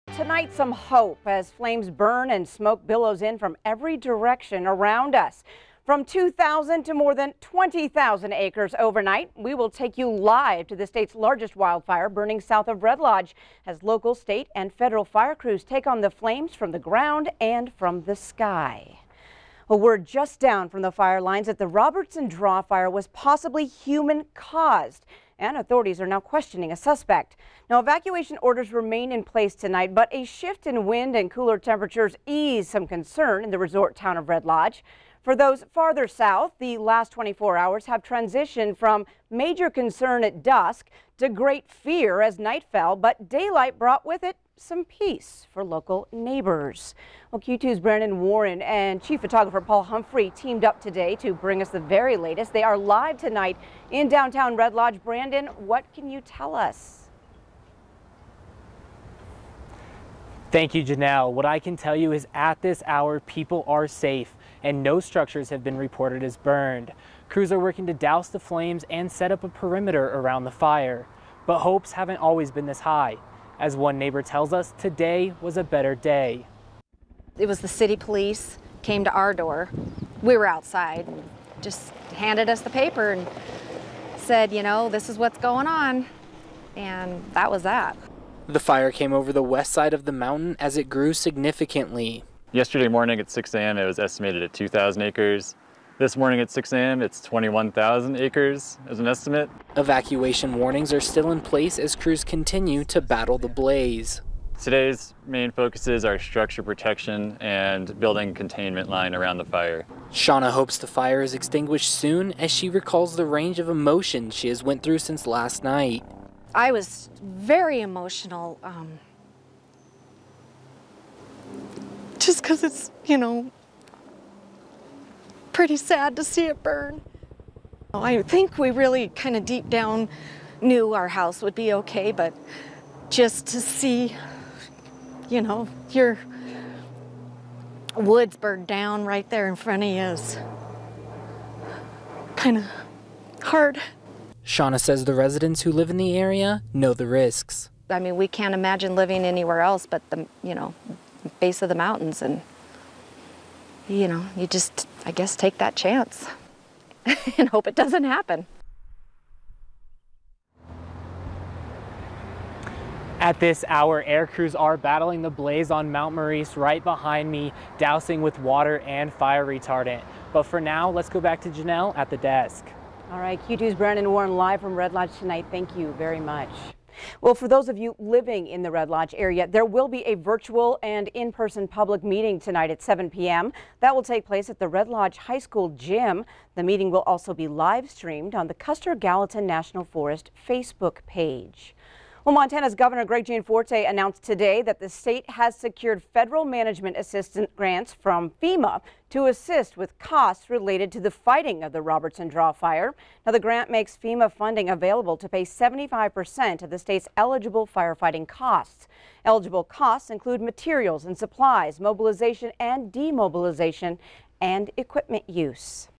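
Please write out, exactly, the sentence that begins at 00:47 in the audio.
Well, Q2's Brandon Warren and chief photographer Paul Humphrey teamed up today to bring us the very latest.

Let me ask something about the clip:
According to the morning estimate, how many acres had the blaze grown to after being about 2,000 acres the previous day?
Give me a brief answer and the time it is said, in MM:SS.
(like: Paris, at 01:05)
21,000 acres, at 01:37.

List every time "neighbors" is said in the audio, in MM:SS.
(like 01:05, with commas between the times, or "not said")
00:46, 01:13.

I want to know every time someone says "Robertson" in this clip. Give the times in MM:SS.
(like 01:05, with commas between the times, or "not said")
00:21, 03:21.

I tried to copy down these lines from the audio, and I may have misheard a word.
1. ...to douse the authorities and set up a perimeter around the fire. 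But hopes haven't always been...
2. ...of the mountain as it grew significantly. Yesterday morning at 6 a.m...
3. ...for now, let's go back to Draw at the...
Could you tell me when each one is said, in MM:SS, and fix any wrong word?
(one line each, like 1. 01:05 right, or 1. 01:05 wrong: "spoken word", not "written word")
1. 01:07 wrong: "flames", not "authorities"
2. 01:29 right
3. 02:50 wrong: "Janelle", not "Draw".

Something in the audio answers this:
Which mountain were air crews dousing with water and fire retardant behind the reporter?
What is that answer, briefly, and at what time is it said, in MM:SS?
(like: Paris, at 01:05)
Mount Maurice, at 02:45.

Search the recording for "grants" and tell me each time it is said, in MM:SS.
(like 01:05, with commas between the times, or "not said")
03:17, 03:23.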